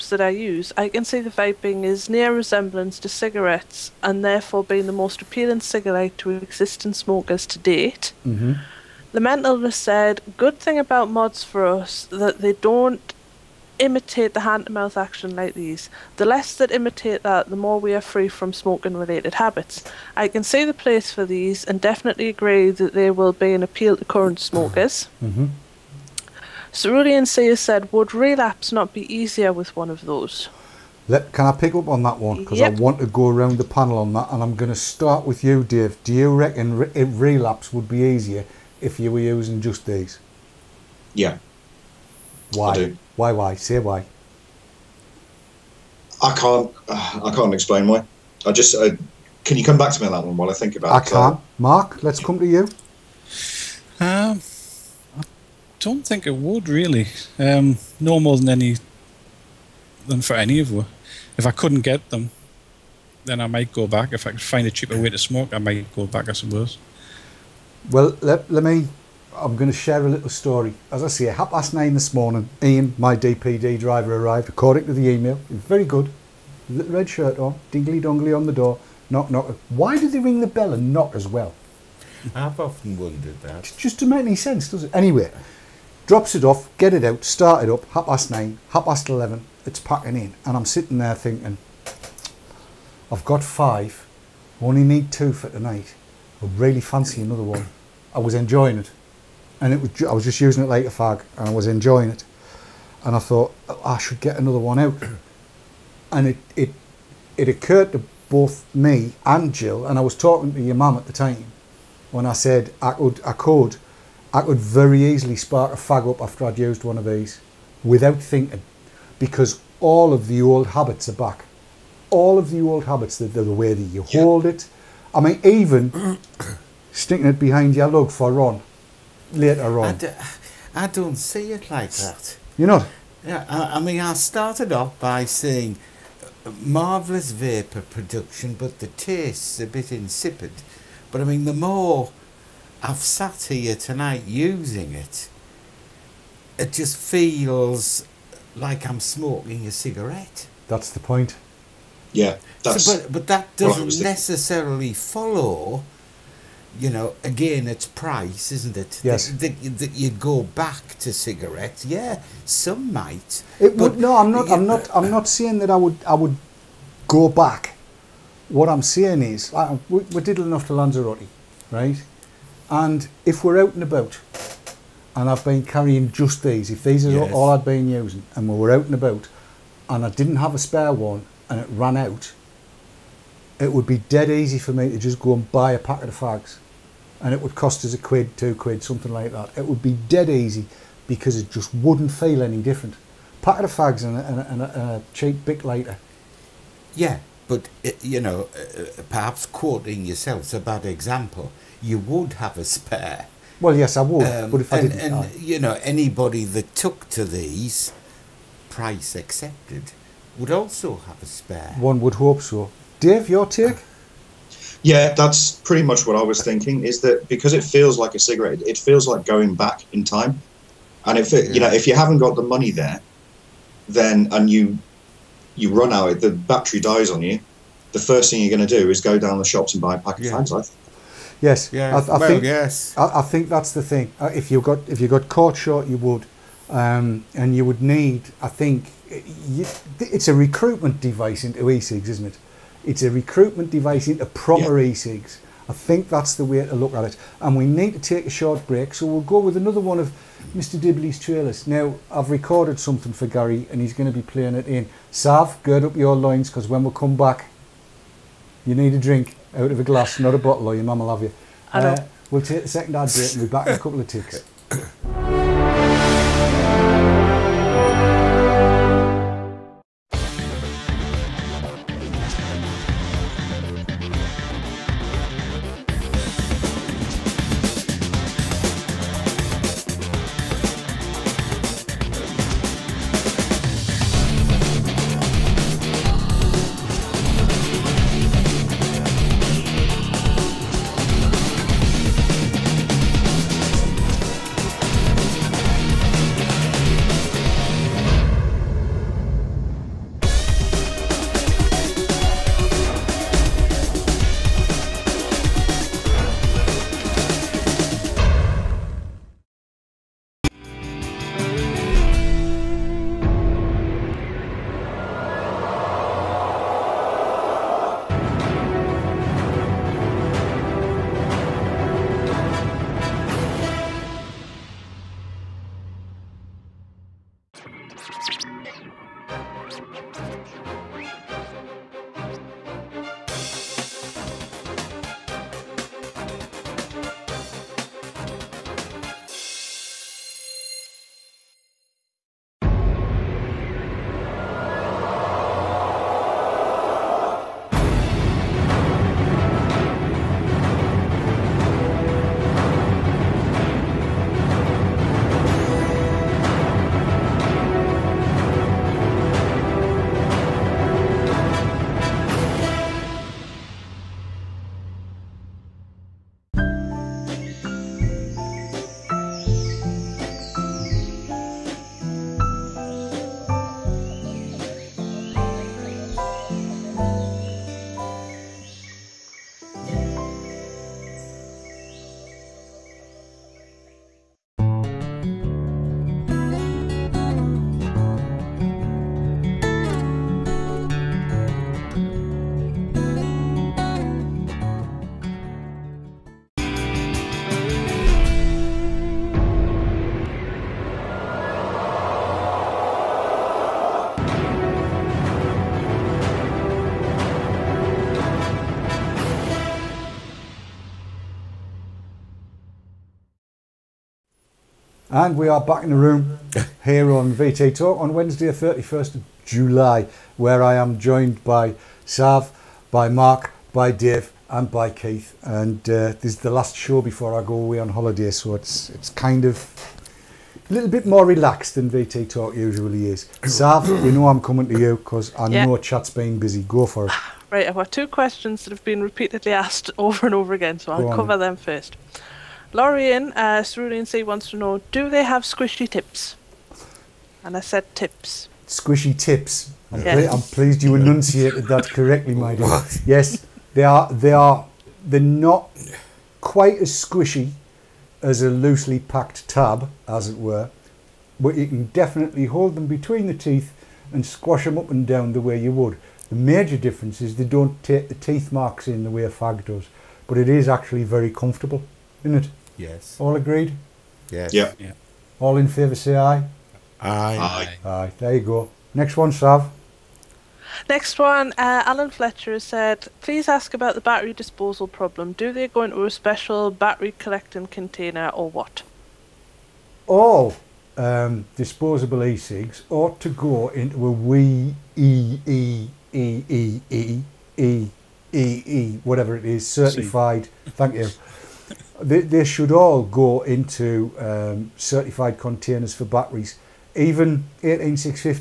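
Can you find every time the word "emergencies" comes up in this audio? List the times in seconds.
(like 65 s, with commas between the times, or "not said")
not said.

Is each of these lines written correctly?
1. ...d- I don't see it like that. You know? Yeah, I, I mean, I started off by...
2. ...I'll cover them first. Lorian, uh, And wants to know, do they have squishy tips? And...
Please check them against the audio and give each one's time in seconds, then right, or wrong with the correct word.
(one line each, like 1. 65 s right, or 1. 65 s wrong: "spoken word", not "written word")
1. 129 s right
2. 440 s wrong: "Cerulean", not "And".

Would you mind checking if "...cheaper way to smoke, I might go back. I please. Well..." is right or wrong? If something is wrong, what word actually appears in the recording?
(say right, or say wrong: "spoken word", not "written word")
wrong: "suppose", not "please".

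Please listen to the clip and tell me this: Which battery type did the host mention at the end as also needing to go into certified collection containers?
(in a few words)
18650s.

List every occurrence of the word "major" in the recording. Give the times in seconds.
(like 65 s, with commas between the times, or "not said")
466 s.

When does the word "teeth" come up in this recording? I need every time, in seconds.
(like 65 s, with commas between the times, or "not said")
463 s, 468 s.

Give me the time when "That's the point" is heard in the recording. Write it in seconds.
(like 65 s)
150 s.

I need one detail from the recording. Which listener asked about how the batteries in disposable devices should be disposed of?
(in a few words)
Alan Fletcher.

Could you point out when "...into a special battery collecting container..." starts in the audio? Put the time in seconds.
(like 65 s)
485 s.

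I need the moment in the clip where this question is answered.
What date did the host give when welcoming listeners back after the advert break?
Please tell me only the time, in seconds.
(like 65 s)
418 s.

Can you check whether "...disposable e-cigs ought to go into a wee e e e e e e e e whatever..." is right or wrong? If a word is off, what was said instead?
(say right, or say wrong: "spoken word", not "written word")
right.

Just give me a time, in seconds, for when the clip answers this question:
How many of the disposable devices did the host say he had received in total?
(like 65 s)
93 s.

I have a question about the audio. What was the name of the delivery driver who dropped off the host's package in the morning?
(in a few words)
Ian.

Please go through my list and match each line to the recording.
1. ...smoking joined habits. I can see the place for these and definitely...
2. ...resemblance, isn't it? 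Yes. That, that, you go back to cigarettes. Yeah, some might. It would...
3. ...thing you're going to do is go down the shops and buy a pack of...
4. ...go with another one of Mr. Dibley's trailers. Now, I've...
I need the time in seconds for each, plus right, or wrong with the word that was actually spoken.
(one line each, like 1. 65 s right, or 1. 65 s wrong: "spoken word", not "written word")
1. 18 s wrong: "related", not "joined"
2. 157 s wrong: "price", not "resemblance"
3. 228 s right
4. 249 s right.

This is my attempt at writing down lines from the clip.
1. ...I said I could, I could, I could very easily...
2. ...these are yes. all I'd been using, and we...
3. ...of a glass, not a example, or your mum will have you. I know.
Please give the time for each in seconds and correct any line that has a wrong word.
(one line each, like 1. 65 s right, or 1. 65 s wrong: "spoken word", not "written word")
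1. 112 s right
2. 176 s right
3. 259 s wrong: "bottle", not "example".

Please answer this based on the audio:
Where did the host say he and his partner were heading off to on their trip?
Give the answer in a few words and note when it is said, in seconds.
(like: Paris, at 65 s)
Lanzarote, at 170 s.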